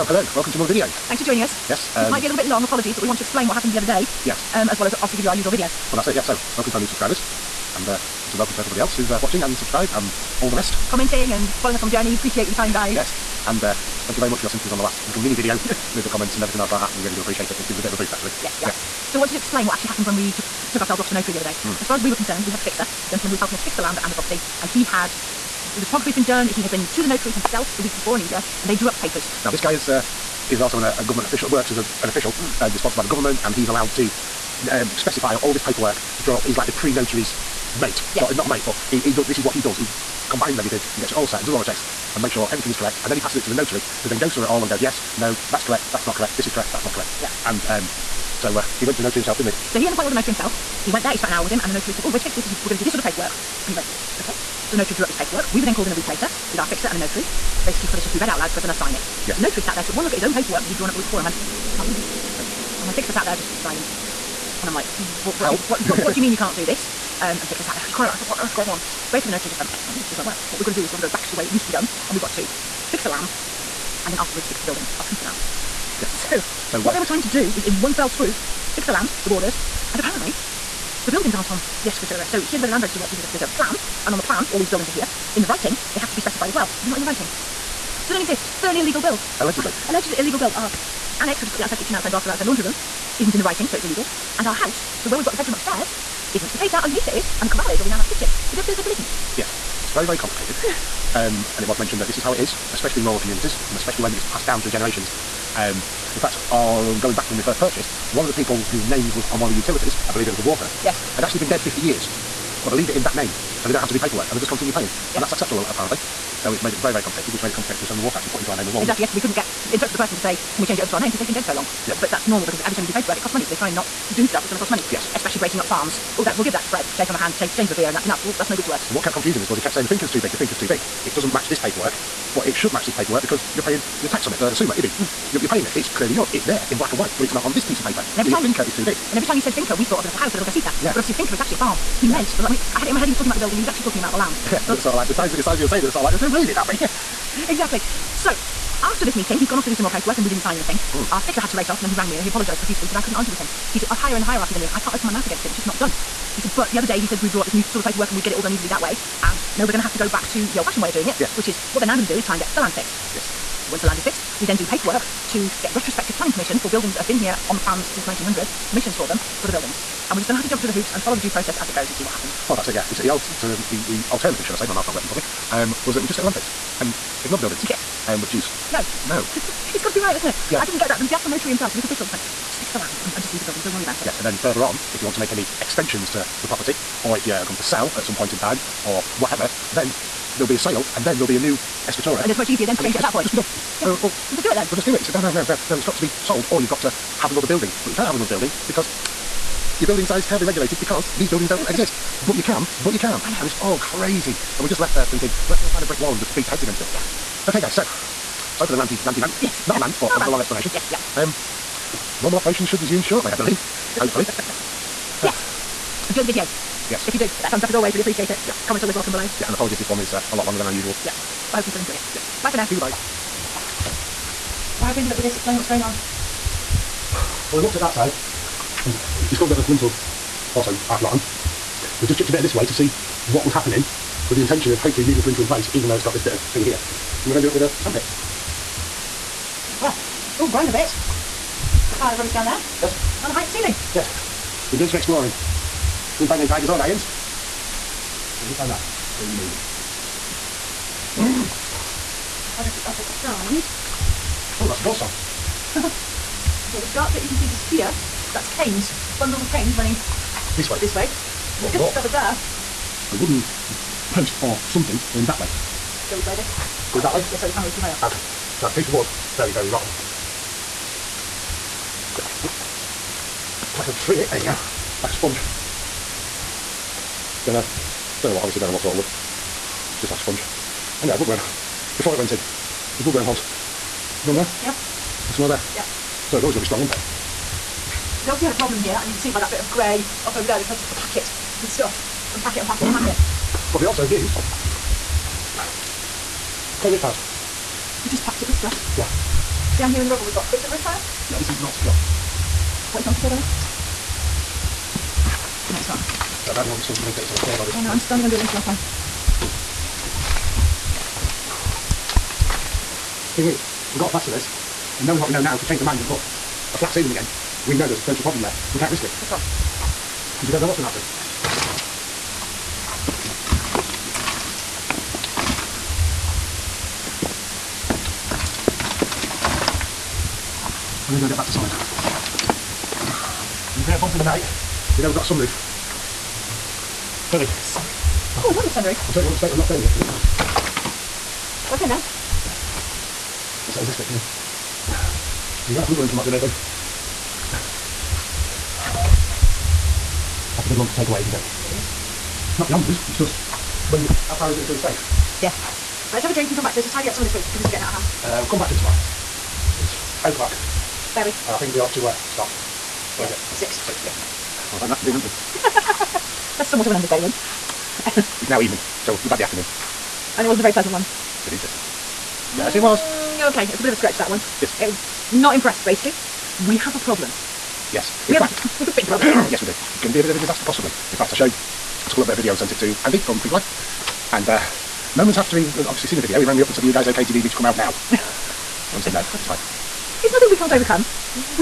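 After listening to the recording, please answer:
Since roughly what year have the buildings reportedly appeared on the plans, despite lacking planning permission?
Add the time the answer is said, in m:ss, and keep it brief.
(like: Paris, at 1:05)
1900, at 2:48.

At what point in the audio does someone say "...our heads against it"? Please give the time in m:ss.
3:26.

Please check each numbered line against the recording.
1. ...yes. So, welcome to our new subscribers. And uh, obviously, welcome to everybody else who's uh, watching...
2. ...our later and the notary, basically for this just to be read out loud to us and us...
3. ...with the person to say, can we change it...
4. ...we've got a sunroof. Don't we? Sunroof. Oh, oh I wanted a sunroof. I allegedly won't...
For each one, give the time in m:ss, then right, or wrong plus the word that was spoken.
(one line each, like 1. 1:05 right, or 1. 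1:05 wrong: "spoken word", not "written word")
1. 0:06 right
2. 0:56 wrong: "fixer", not "later"
3. 1:59 right
4. 5:35 wrong: "certainly", not "allegedly".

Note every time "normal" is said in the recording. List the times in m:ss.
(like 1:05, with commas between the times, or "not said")
2:02, 3:32.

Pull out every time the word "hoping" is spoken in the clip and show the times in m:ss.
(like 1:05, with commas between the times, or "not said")
not said.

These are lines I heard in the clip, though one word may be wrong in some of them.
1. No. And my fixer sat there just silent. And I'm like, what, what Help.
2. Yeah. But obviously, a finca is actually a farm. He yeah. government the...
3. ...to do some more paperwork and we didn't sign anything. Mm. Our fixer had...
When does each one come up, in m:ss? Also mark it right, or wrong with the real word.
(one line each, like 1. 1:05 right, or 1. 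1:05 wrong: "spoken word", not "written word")
1. 1:02 right
2. 2:20 wrong: "meant", not "government"
3. 2:29 right.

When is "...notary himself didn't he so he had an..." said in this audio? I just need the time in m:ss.
0:49.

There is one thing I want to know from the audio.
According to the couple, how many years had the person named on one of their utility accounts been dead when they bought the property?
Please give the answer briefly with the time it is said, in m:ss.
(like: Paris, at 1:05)
50, at 1:51.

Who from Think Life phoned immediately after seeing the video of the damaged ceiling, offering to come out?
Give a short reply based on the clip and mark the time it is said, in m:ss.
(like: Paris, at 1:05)
Andy, at 6:23.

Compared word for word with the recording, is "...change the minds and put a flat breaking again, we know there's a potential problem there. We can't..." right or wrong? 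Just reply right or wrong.
wrong.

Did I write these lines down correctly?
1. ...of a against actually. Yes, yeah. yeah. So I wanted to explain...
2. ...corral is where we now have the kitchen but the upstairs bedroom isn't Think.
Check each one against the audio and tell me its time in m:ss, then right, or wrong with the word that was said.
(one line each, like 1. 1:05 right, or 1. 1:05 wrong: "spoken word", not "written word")
1. 0:17 wrong: "boost", not "against"
2. 1:37 wrong: "Yes", not "Think".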